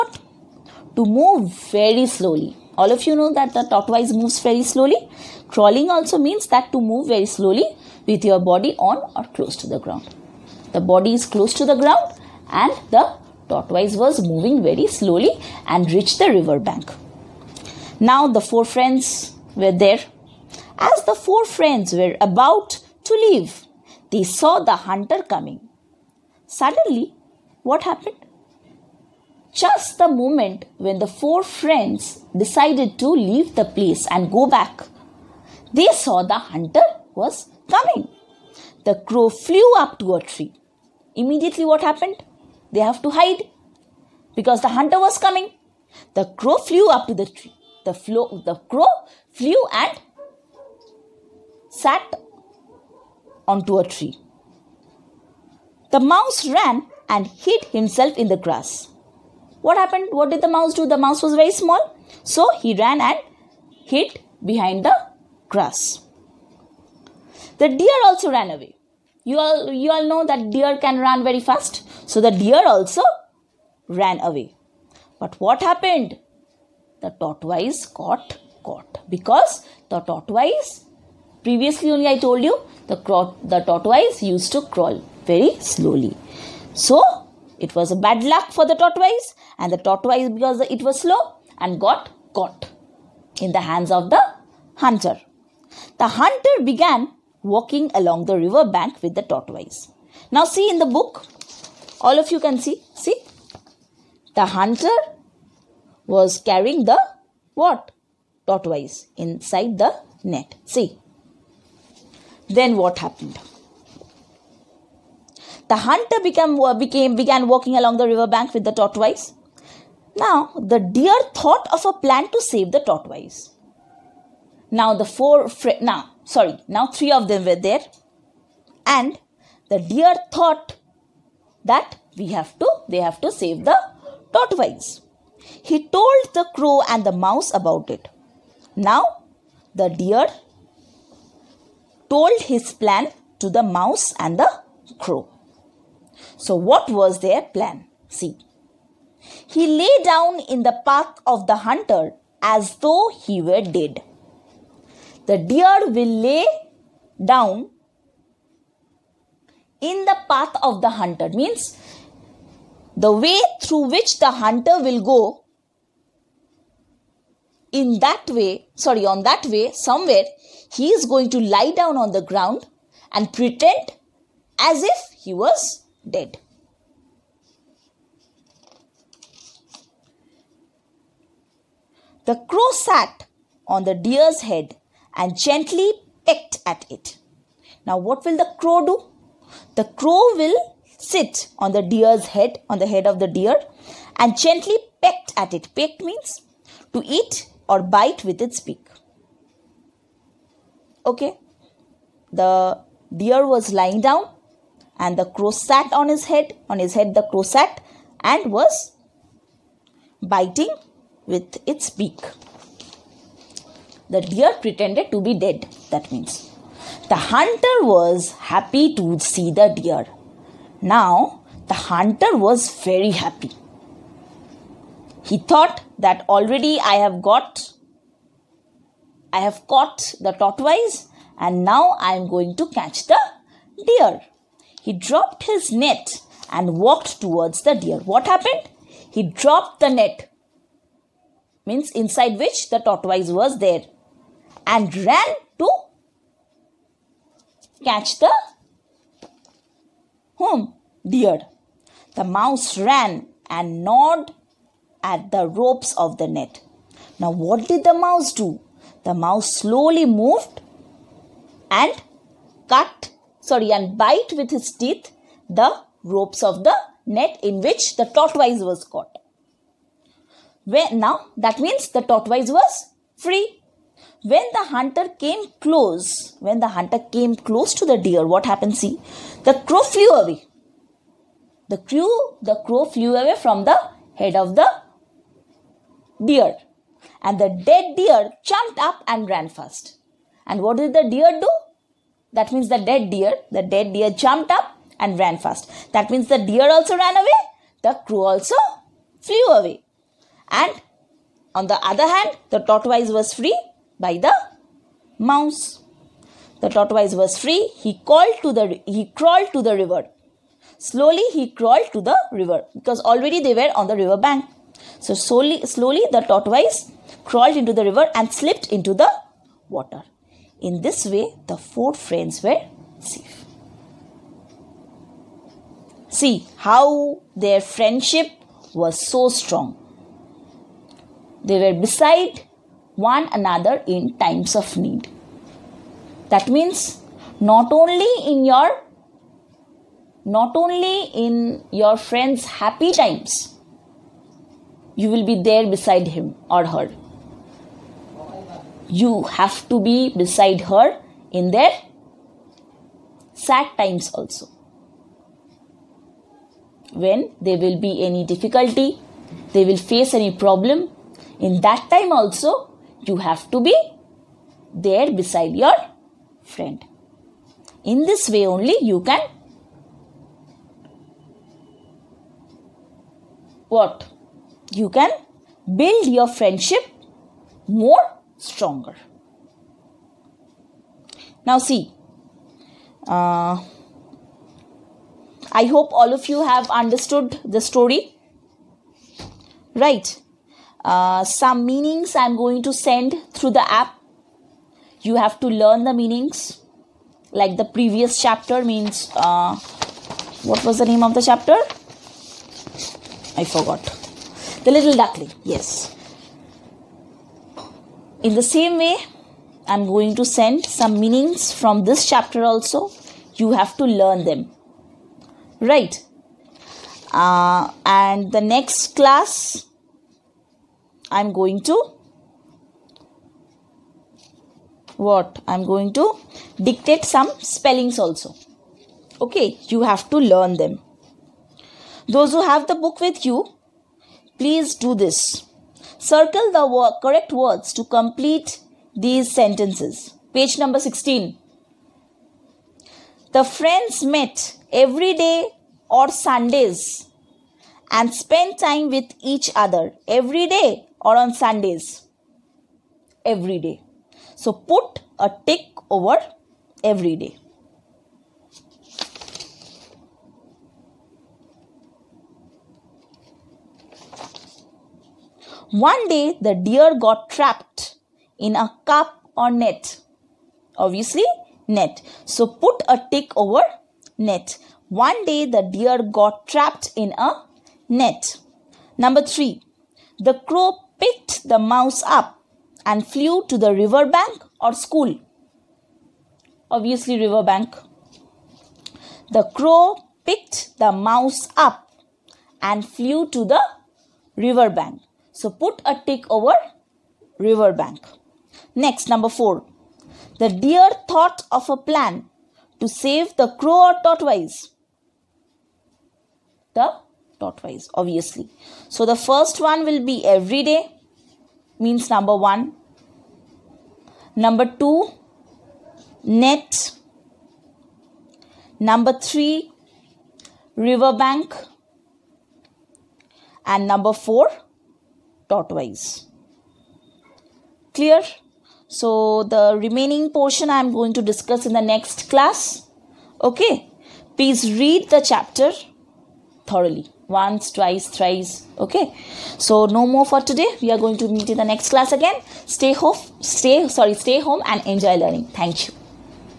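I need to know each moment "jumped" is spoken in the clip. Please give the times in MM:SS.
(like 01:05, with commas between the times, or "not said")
04:48, 04:54.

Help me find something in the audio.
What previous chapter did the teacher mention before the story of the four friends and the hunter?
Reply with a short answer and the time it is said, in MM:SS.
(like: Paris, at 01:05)
The Little Duckling, at 06:44.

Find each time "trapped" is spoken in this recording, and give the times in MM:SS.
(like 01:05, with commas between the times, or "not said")
07:47, 07:56.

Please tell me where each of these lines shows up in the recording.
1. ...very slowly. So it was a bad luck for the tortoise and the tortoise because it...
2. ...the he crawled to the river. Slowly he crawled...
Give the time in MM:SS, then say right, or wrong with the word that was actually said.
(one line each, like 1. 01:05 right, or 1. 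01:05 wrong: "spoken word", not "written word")
1. 01:25 right
2. 05:08 right.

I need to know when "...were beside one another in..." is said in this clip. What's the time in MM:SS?
05:31.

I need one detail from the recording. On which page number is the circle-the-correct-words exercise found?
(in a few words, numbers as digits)
16.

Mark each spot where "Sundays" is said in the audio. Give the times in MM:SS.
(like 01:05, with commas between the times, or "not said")
07:26, 07:31.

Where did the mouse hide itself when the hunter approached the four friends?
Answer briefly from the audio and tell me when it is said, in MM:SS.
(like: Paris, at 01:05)
in the grass, at 00:58.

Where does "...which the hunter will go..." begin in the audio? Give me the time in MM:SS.
02:43.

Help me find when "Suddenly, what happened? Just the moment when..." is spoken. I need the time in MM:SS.
00:26.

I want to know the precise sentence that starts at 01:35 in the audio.
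The hunter began walking along the river bank with the tortoise.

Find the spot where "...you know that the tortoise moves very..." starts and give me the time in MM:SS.
00:03.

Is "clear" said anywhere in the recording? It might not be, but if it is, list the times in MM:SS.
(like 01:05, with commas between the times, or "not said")
08:47.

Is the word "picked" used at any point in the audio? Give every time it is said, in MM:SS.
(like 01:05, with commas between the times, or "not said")
08:00, 08:10.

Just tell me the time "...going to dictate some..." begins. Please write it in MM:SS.
07:05.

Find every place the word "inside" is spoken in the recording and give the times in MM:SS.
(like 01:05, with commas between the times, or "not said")
01:49, 04:01.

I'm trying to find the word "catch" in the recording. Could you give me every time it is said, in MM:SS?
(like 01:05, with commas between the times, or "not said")
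03:52, 04:07.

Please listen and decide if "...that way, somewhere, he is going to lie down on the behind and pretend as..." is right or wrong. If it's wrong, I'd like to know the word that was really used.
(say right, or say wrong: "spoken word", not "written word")
wrong: "ground", not "behind".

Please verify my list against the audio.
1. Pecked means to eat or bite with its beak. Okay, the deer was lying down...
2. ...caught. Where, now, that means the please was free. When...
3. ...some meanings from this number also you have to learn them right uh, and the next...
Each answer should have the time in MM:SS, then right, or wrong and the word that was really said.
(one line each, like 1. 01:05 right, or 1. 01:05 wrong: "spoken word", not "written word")
1. 03:15 right
2. 04:28 wrong: "tortoise", not "please"
3. 06:50 wrong: "chapter", not "number".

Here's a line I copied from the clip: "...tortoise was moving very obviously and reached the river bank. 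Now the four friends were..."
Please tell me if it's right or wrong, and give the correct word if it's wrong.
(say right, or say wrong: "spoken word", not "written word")
wrong: "slowly", not "obviously".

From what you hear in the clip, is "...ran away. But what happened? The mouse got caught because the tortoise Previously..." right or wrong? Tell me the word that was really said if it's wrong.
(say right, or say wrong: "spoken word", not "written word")
wrong: "tortoise", not "mouse".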